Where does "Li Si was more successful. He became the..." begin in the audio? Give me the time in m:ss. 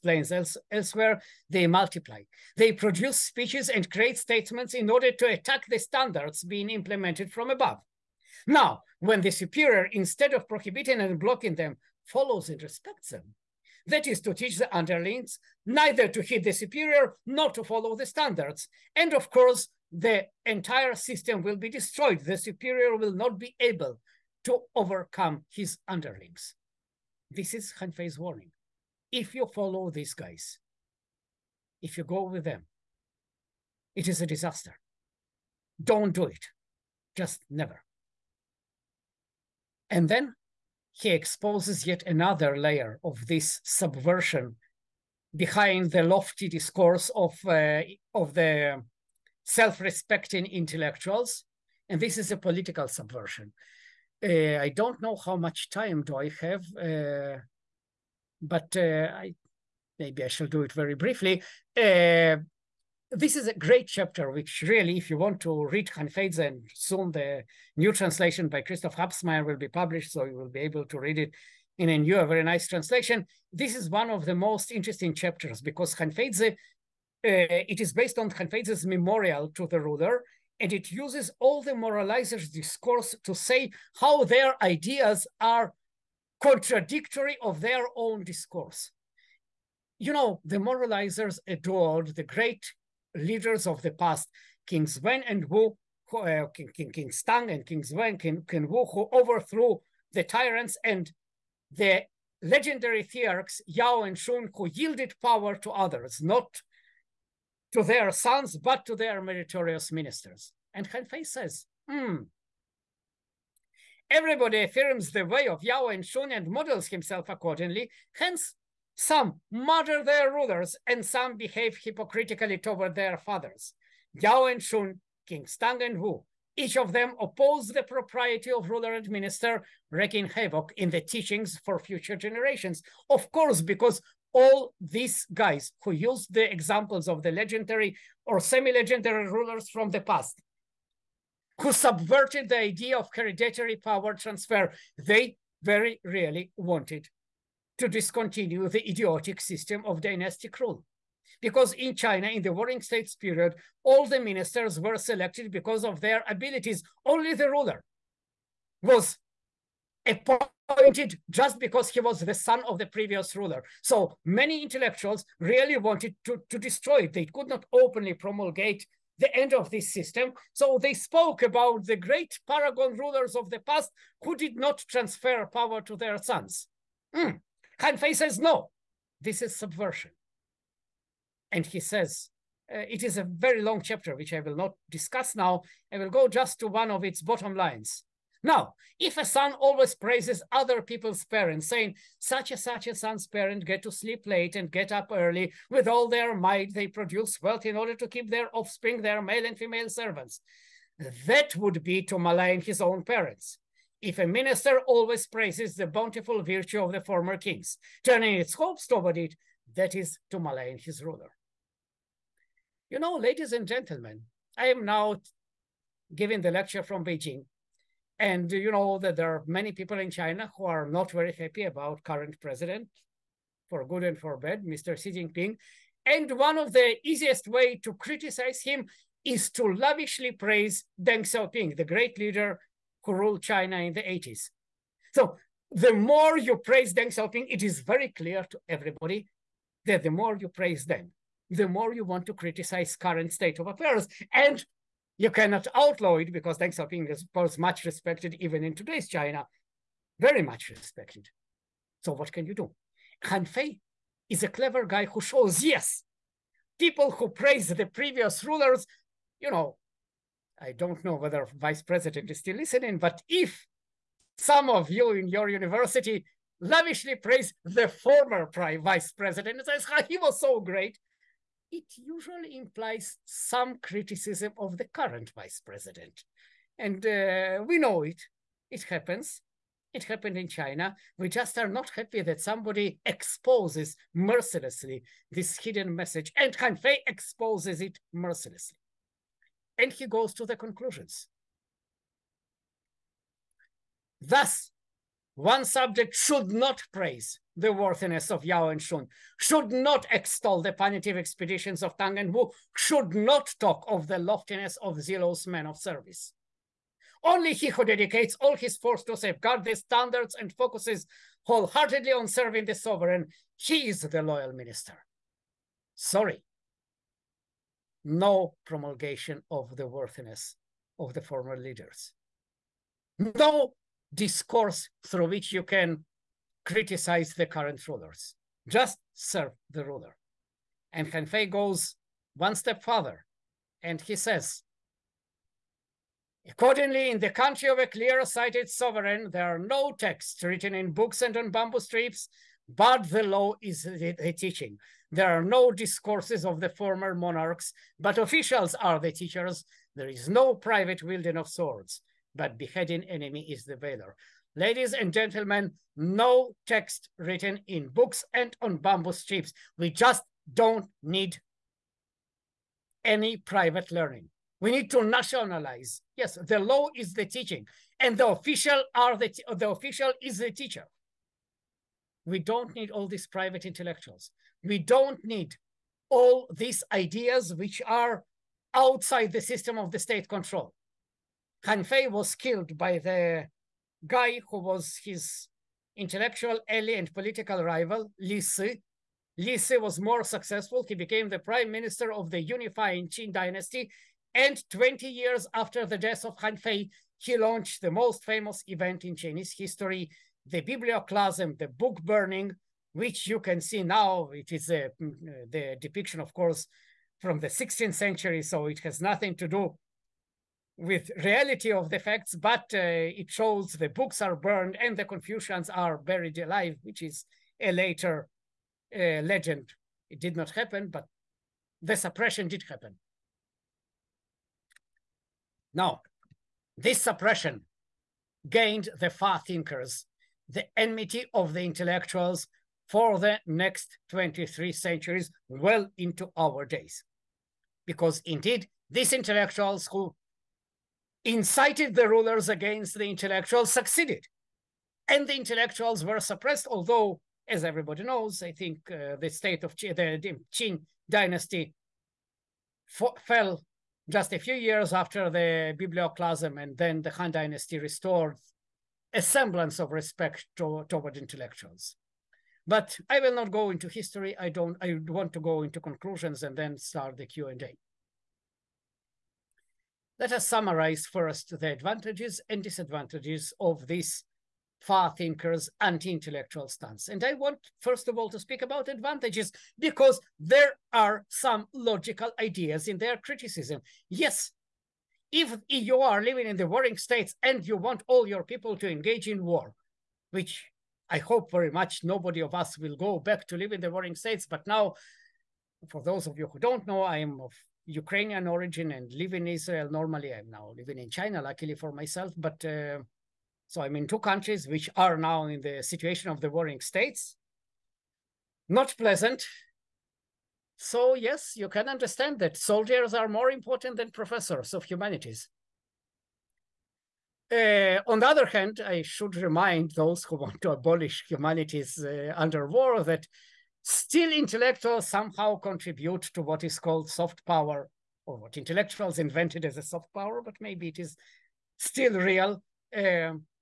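6:29.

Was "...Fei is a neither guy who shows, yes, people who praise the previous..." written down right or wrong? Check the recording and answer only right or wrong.
wrong.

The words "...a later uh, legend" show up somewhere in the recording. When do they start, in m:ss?
6:57.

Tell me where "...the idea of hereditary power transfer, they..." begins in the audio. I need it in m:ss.
2:22.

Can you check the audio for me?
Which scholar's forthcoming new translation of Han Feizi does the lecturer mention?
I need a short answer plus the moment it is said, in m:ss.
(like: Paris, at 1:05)
Christoph Harbsmeier, at 1:08.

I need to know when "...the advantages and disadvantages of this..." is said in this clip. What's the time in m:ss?
7:51.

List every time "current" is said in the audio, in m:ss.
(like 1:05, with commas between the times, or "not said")
3:42, 4:02, 4:34, 5:27.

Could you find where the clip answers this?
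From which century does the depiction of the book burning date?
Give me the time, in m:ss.
6:47.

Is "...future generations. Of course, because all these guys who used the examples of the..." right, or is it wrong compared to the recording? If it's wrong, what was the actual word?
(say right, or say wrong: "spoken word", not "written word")
right.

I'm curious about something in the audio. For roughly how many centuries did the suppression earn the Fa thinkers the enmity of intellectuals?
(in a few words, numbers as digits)
23.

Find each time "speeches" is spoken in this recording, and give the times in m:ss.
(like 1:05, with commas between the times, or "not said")
0:03.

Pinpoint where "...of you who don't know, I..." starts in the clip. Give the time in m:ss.
8:16.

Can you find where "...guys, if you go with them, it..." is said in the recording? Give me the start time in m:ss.
0:30.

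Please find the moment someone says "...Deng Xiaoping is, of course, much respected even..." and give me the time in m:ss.
4:06.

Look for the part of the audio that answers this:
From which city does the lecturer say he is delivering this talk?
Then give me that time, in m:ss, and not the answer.
3:37.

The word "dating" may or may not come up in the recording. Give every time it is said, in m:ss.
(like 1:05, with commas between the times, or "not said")
not said.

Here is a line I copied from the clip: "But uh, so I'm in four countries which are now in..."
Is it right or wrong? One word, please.
wrong.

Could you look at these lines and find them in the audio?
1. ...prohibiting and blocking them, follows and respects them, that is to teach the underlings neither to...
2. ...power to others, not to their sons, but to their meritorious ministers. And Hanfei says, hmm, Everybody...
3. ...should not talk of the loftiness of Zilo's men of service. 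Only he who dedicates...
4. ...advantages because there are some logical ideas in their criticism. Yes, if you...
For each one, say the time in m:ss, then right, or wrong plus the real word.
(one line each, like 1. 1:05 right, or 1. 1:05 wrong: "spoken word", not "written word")
1. 0:10 right
2. 1:45 right
3. 5:02 right
4. 7:58 right.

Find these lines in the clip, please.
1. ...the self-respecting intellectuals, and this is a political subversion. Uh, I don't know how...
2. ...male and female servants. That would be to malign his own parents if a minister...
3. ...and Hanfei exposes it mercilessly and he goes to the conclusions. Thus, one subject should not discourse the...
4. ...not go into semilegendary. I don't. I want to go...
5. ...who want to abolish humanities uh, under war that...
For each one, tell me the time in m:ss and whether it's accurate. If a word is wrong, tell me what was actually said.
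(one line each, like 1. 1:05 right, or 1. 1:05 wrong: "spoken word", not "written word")
1. 0:48 right
2. 3:19 right
3. 4:46 wrong: "praise", not "discourse"
4. 7:43 wrong: "history", not "semilegendary"
5. 8:40 right.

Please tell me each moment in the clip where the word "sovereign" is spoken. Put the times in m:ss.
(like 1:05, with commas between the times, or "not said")
5:12, 5:38.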